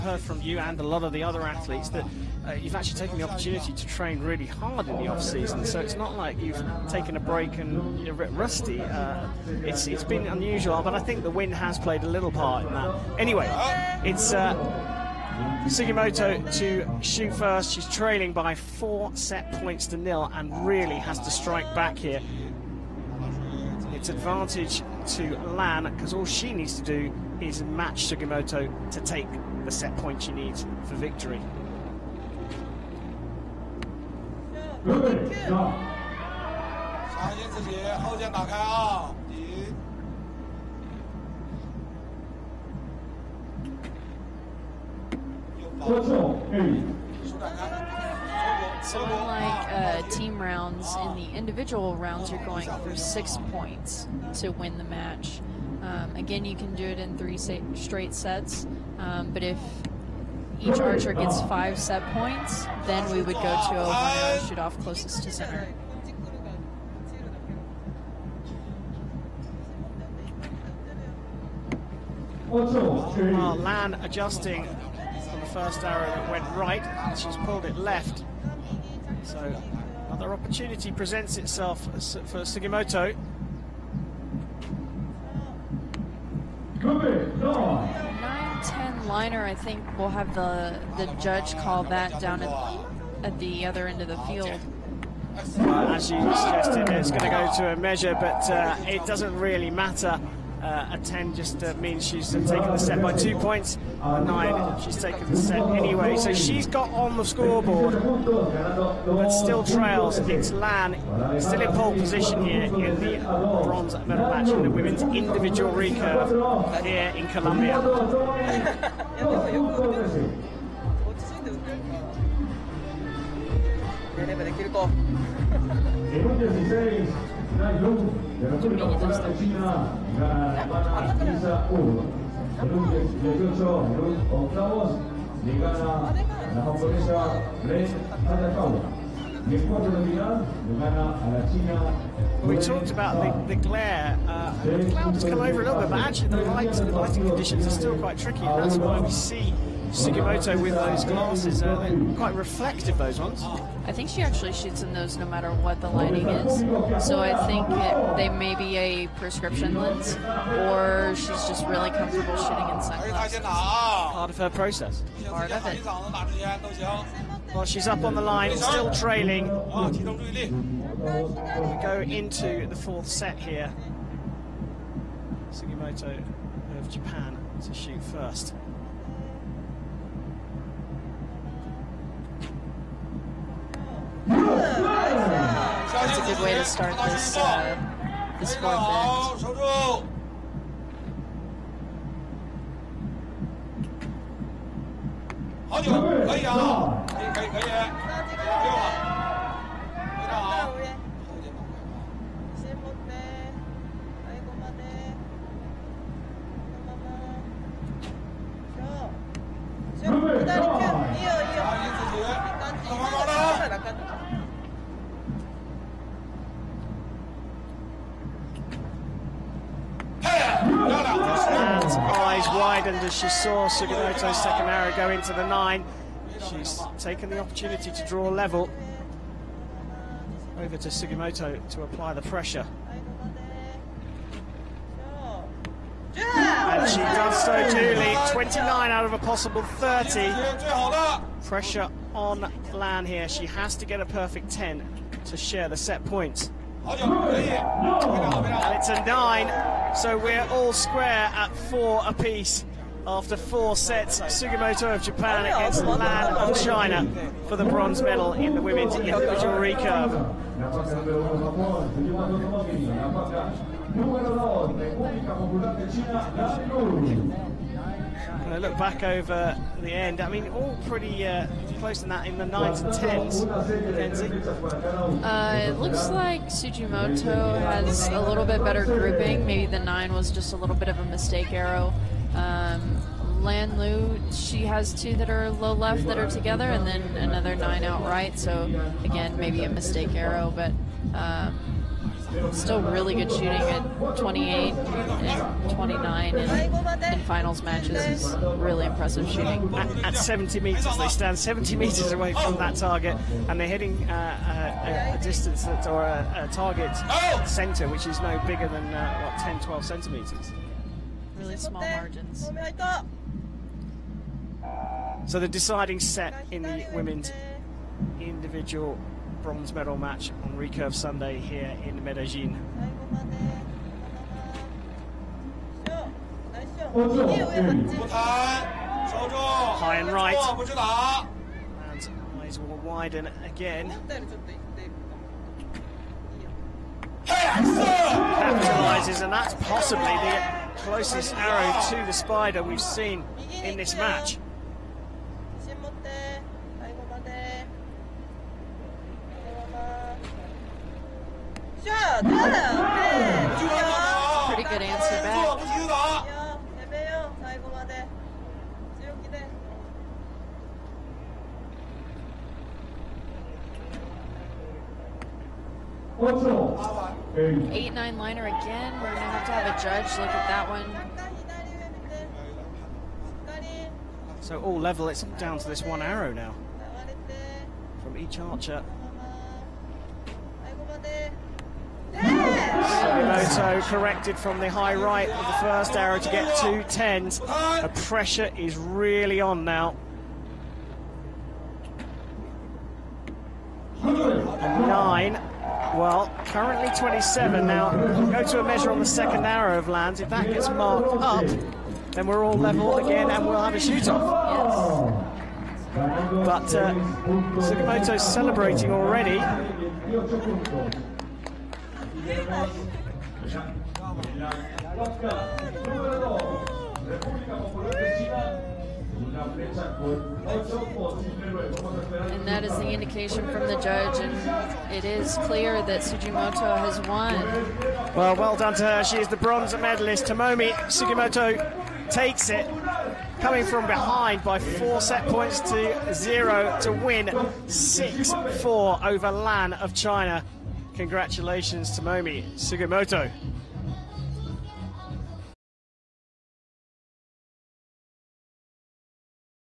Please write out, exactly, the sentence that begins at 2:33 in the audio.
I think she actually shoots in those no matter what the lighting is.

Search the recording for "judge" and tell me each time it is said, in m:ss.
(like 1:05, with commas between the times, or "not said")
1:31, 6:09, 7:03.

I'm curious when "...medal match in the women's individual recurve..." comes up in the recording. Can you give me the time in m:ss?
1:53.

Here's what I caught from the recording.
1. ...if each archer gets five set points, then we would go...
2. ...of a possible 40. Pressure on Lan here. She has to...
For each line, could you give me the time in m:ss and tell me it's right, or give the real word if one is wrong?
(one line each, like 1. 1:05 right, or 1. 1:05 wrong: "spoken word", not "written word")
1. 0:59 right
2. 3:59 wrong: "30", not "40".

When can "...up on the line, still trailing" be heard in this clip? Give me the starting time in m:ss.
2:47.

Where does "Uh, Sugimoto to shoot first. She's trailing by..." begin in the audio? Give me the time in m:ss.
0:14.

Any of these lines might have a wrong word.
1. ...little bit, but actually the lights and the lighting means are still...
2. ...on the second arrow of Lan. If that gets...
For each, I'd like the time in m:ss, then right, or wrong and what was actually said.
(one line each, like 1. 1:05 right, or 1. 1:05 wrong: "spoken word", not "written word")
1. 2:25 wrong: "conditions", not "means"
2. 6:38 right.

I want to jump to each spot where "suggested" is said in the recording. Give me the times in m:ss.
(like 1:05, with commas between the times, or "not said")
1:36.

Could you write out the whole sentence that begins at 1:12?
Oh, Lan adjusting for the first arrow that went right.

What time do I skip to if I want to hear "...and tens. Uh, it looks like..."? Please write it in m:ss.
4:32.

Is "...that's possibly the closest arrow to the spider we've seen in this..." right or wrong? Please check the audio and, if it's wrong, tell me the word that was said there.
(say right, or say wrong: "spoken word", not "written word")
right.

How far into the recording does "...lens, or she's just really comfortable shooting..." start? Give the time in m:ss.
2:39.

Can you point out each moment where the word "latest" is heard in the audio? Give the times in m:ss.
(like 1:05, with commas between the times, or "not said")
not said.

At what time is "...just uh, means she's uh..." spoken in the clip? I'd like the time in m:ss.
1:41.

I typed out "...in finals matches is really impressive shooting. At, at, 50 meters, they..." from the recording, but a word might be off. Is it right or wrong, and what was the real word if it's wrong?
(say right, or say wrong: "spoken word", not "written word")
wrong: "70", not "50".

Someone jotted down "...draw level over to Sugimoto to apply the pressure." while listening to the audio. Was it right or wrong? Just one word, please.
right.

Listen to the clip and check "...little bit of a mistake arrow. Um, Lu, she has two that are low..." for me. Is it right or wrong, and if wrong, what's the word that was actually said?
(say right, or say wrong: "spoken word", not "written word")
right.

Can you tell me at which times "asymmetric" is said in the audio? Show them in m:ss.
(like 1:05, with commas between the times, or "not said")
not said.